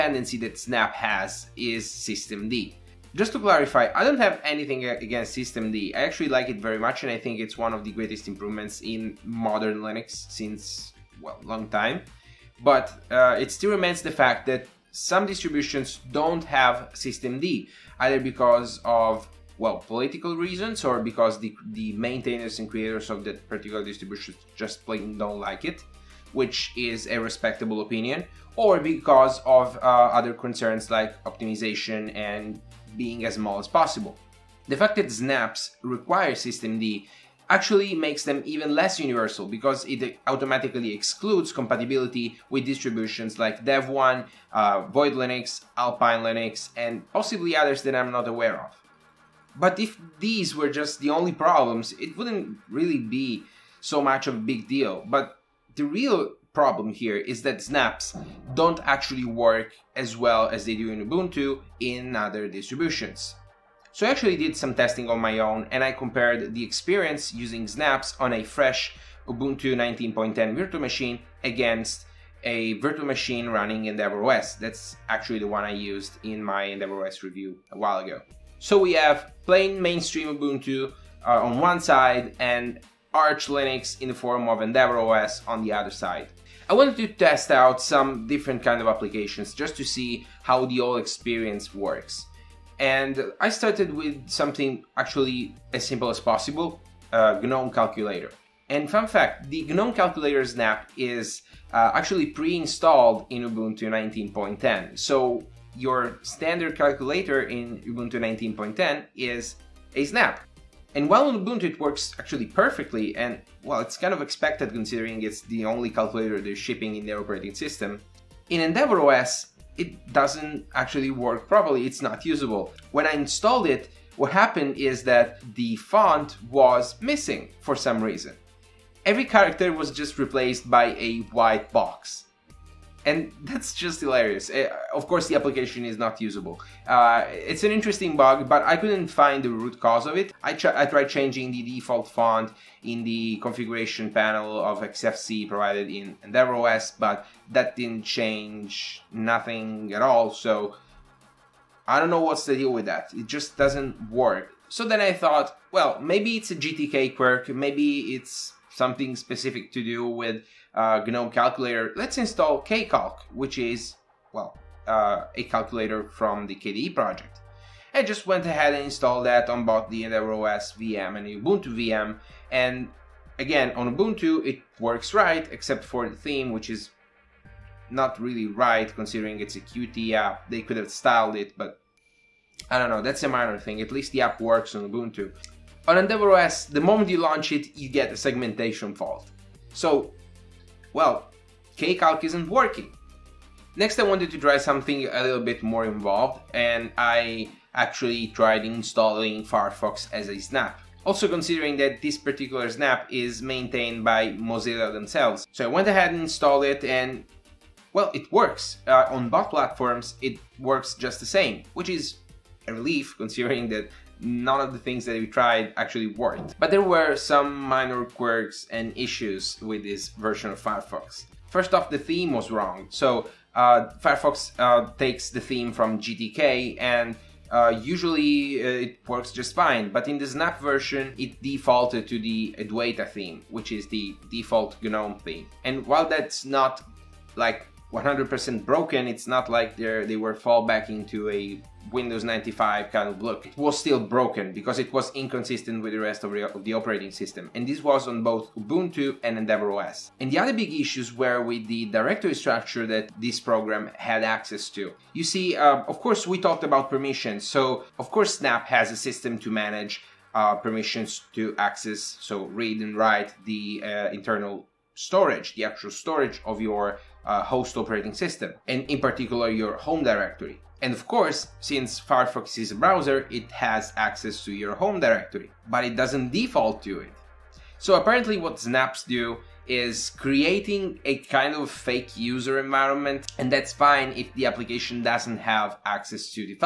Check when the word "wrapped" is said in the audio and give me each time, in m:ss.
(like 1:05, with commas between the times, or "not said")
not said.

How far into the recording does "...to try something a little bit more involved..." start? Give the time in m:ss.
3:14.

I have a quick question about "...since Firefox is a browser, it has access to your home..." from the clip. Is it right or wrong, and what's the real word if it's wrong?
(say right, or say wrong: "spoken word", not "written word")
right.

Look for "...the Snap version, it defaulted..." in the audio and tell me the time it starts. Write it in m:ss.
3:50.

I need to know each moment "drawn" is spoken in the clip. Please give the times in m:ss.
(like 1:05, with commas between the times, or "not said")
not said.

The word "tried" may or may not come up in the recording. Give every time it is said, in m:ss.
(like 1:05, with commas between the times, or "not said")
2:20, 3:18, 3:35.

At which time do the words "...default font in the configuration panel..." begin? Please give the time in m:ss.
2:21.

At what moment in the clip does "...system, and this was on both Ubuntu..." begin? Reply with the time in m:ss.
4:07.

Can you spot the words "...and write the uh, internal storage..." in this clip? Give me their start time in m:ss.
4:22.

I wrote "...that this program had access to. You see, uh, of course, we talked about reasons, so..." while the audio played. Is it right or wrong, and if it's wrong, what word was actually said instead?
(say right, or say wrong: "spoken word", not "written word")
wrong: "permissions", not "reasons".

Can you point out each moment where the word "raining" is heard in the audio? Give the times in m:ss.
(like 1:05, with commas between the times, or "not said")
not said.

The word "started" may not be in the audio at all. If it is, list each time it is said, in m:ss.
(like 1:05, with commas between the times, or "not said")
1:33.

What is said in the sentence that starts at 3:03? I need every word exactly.
At least the app works on Ubuntu.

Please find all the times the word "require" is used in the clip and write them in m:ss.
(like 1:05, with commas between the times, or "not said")
0:35.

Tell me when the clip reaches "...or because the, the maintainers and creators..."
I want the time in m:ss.
0:20.